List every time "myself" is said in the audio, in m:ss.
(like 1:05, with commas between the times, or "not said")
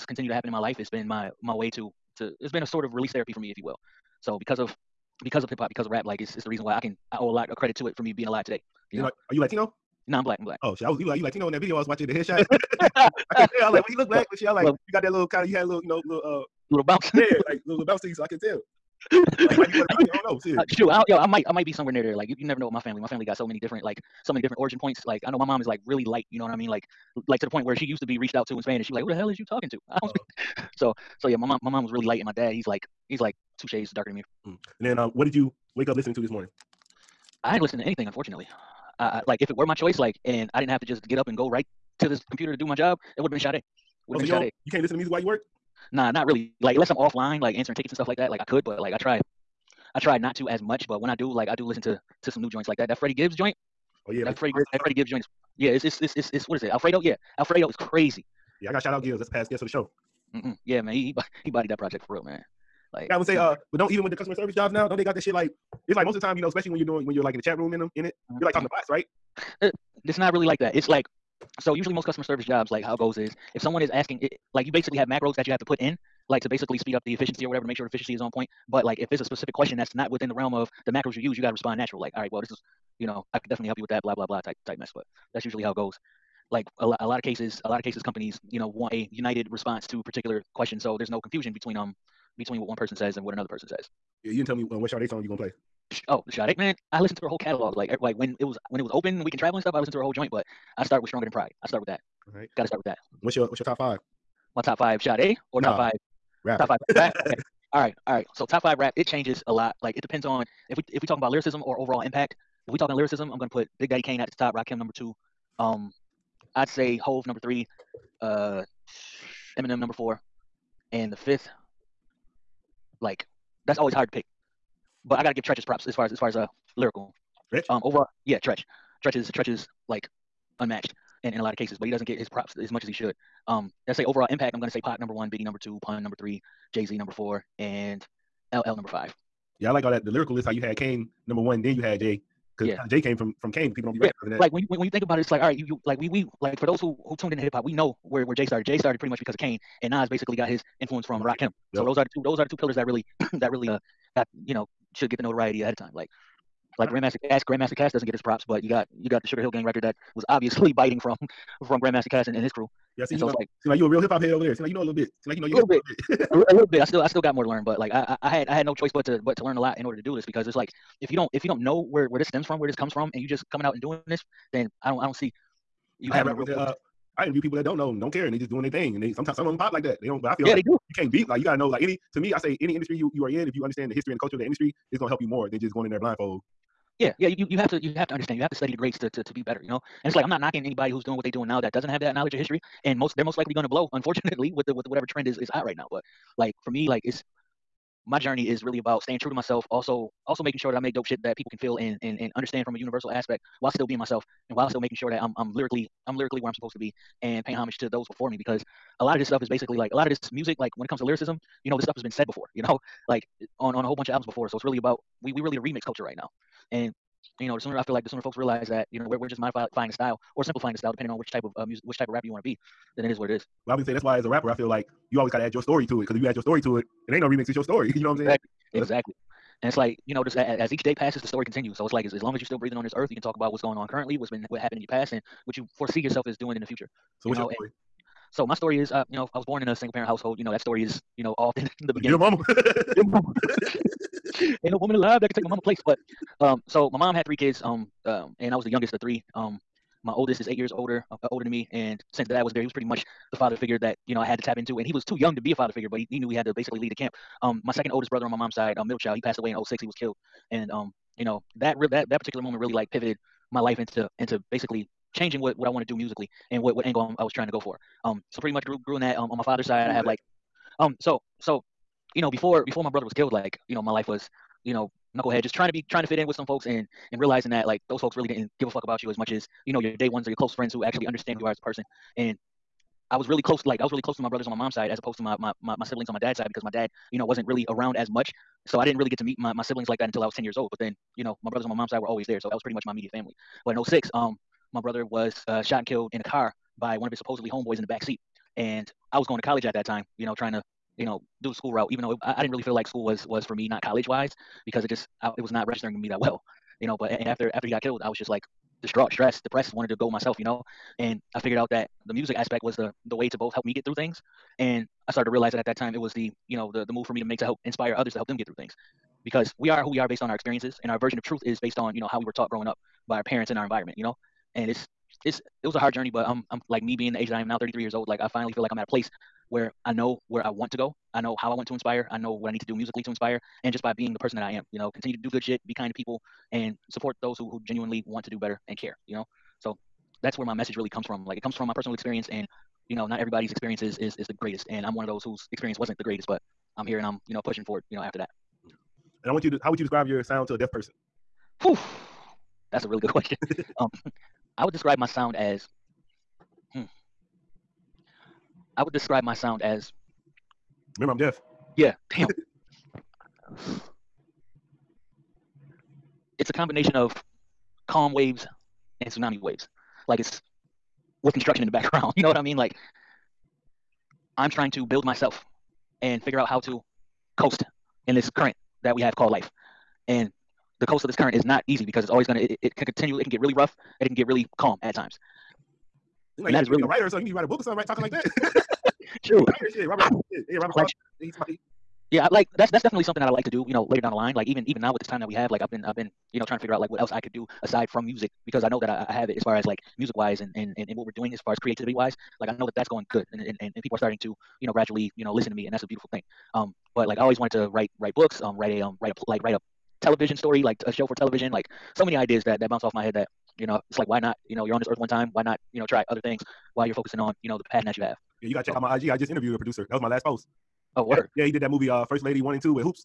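3:19, 3:23, 5:10, 6:15.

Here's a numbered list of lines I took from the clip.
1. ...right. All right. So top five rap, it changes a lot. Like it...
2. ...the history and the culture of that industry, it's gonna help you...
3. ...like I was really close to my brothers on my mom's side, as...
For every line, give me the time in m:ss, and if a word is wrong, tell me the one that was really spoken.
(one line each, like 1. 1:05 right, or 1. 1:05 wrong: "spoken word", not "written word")
1. 1:47 right
2. 3:03 right
3. 4:43 right.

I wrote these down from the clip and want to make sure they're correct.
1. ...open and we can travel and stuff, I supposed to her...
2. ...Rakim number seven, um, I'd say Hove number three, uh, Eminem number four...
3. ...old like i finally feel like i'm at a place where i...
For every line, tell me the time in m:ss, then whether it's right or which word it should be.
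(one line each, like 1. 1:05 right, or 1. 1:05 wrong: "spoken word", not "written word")
1. 1:38 wrong: "listened", not "supposed"
2. 1:54 wrong: "two", not "seven"
3. 5:27 right.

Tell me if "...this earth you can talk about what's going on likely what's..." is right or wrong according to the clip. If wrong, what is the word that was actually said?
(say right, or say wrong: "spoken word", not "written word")
wrong: "currently", not "likely".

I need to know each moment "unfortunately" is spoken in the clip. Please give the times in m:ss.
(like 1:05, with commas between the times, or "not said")
0:38, 3:13.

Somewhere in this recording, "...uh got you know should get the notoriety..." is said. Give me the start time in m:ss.
2:33.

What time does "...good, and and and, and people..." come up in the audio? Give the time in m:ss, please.
6:43.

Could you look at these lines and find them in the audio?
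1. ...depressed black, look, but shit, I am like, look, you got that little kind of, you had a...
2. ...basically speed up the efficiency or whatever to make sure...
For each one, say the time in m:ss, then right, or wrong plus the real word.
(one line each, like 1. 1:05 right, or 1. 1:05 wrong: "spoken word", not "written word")
1. 0:13 wrong: "looked", not "depressed"
2. 1:16 right.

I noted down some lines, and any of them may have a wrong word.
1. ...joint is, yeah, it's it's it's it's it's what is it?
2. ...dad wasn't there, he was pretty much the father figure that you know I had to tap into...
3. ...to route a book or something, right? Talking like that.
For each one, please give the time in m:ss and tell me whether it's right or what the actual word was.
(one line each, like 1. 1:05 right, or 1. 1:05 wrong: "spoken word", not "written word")
1. 0:55 right
2. 4:12 right
3. 6:27 wrong: "write", not "route".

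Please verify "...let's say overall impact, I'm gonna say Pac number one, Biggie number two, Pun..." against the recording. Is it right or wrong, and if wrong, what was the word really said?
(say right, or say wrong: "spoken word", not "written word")
right.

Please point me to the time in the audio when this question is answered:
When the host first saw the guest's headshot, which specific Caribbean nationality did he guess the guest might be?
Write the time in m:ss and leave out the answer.
0:19.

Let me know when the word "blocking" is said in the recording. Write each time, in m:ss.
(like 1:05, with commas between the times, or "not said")
not said.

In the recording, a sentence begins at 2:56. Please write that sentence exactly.
uh, I interview people that don't know them, don't care, and they just doing their thing.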